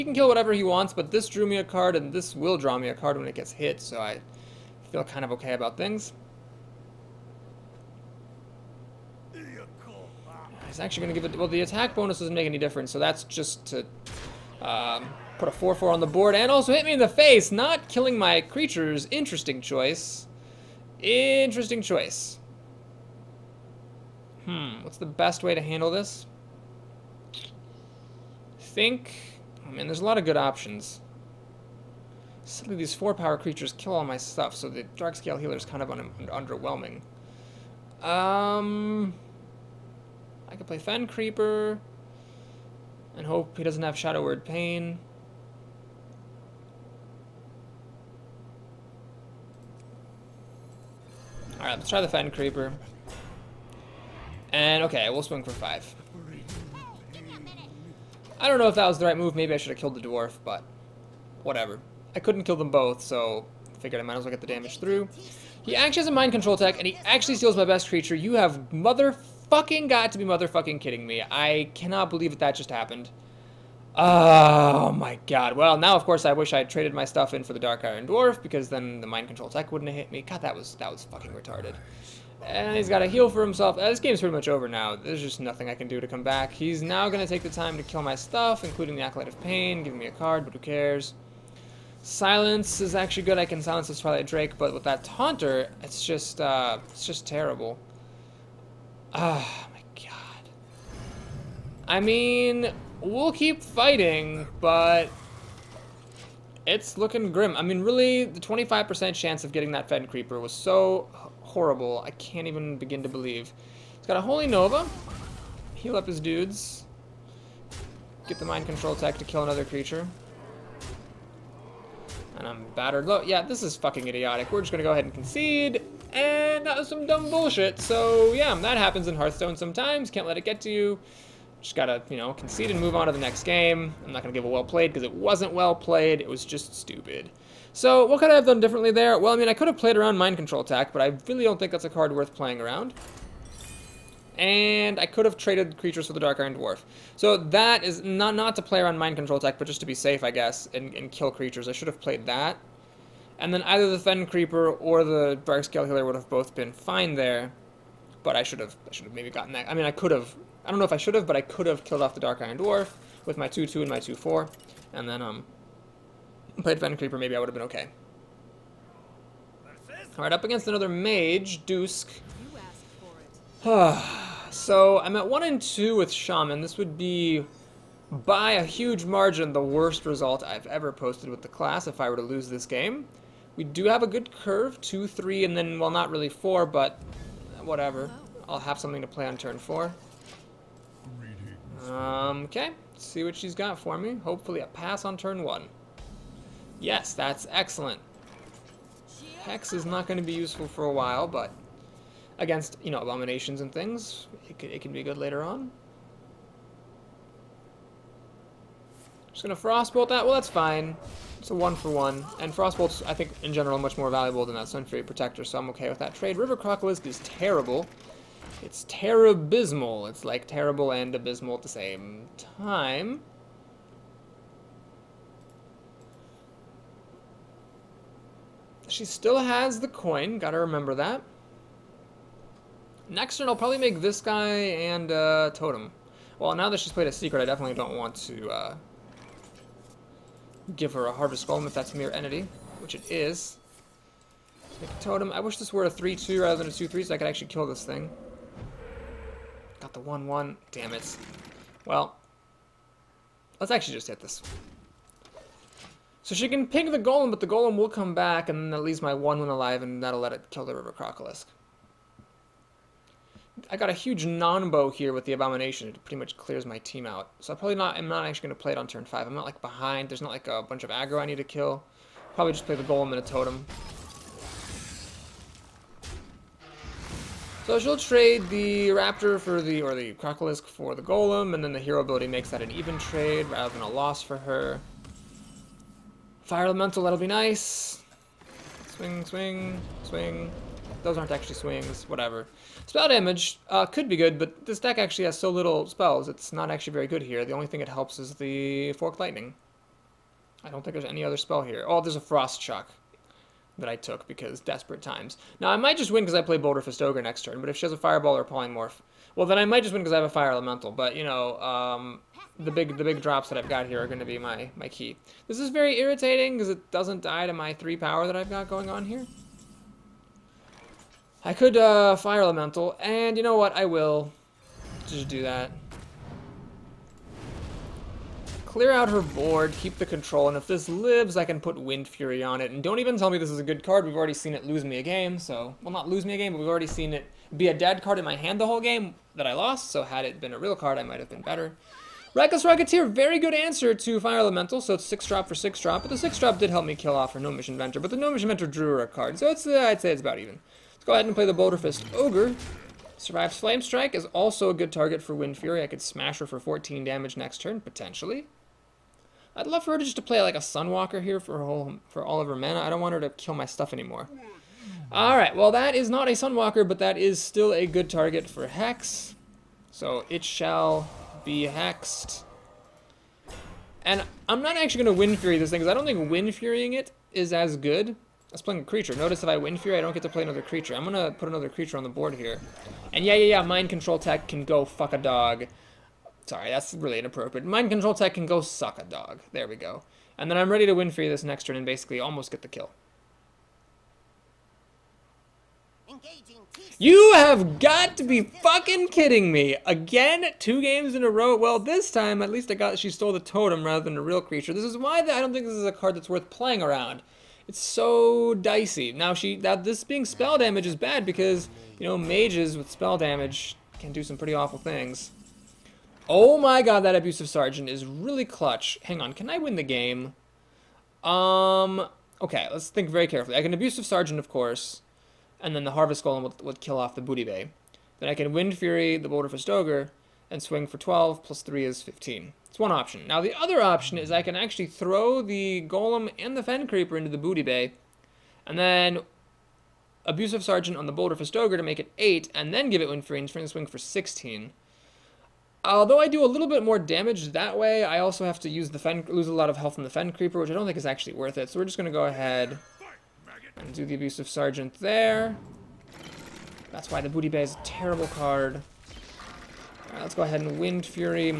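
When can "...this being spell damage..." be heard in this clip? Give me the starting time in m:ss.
6:49.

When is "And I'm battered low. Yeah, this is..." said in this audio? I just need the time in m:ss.
2:02.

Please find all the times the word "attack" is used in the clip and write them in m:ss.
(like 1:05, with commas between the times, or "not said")
0:11, 1:58, 2:20, 2:29.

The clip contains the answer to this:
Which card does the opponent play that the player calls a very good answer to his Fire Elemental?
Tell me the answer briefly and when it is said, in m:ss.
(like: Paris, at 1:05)
Reckless Rocketeer, at 5:42.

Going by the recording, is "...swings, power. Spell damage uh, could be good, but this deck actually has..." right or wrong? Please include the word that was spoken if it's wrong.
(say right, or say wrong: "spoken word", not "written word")
wrong: "whatever", not "power".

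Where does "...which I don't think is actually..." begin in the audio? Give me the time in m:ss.
7:30.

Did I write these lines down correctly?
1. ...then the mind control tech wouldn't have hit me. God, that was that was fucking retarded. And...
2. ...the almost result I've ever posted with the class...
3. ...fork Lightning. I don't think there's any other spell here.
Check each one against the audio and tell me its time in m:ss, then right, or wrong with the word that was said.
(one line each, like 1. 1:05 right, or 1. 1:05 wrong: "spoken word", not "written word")
1. 1:18 right
2. 2:59 wrong: "worst", not "almost"
3. 4:58 right.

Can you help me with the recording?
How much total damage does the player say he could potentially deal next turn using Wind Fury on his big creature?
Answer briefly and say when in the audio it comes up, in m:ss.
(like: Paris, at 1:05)
14, at 5:56.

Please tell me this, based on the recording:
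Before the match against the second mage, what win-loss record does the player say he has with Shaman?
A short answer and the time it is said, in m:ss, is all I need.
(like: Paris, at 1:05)
1 and 2, at 2:55.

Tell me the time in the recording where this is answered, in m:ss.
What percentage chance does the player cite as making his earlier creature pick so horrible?
1:48.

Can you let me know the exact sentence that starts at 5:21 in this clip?
I could uh, Fire Elemental, and you know what?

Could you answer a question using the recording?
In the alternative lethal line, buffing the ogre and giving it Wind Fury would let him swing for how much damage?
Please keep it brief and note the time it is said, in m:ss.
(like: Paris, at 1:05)
16, at 7:23.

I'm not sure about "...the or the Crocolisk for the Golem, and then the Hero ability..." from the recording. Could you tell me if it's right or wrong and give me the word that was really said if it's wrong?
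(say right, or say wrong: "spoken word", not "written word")
right.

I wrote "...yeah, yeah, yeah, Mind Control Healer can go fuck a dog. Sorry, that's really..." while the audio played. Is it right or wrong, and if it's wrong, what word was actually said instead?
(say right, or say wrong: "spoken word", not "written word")
wrong: "Tech", not "Healer".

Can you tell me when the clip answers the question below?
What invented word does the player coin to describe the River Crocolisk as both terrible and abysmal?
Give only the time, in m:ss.
3:38.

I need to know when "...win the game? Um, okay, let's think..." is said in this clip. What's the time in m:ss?
6:59.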